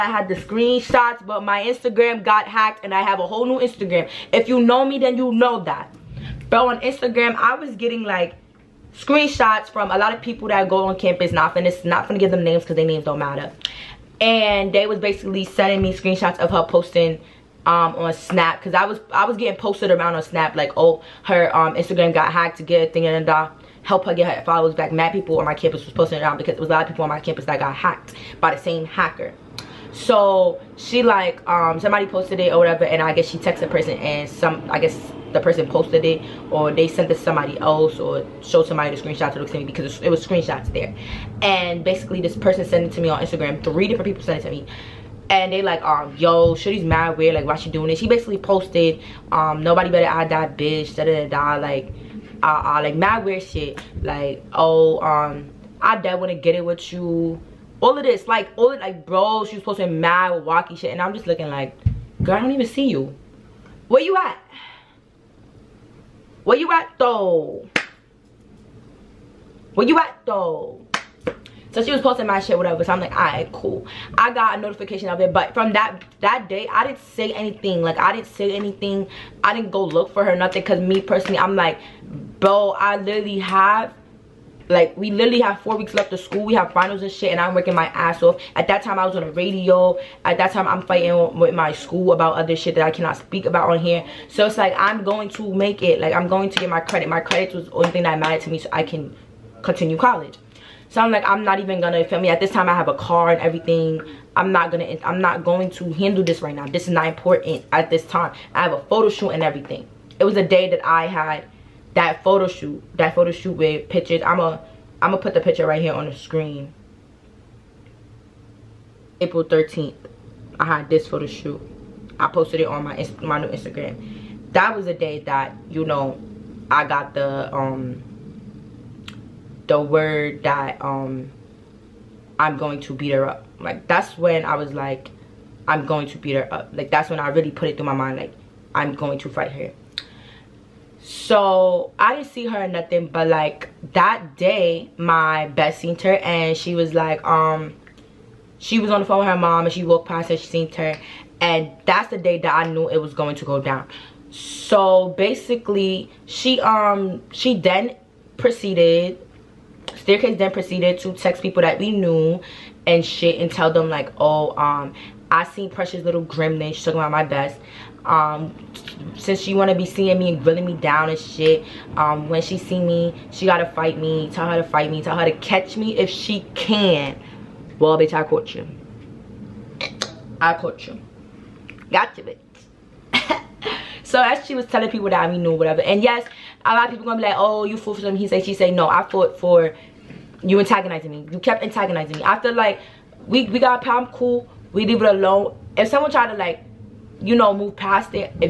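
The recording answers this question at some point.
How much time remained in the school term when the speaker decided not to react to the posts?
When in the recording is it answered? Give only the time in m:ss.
1:25.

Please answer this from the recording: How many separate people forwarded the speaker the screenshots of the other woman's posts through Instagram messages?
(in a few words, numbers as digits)
3.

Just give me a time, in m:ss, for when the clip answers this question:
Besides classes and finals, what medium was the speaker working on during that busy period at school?
1:29.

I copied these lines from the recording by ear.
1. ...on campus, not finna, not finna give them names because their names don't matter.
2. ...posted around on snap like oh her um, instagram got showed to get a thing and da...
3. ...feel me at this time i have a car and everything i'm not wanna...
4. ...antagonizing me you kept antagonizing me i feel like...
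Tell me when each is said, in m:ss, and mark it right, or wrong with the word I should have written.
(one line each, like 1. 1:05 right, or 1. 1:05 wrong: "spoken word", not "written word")
1. 0:10 right
2. 0:19 wrong: "hacked", not "showed"
3. 1:42 wrong: "gonna", not "wanna"
4. 3:10 right.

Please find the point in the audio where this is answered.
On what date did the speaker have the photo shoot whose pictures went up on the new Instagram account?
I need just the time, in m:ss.
1:59.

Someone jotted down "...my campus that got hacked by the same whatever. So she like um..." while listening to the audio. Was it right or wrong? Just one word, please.
wrong.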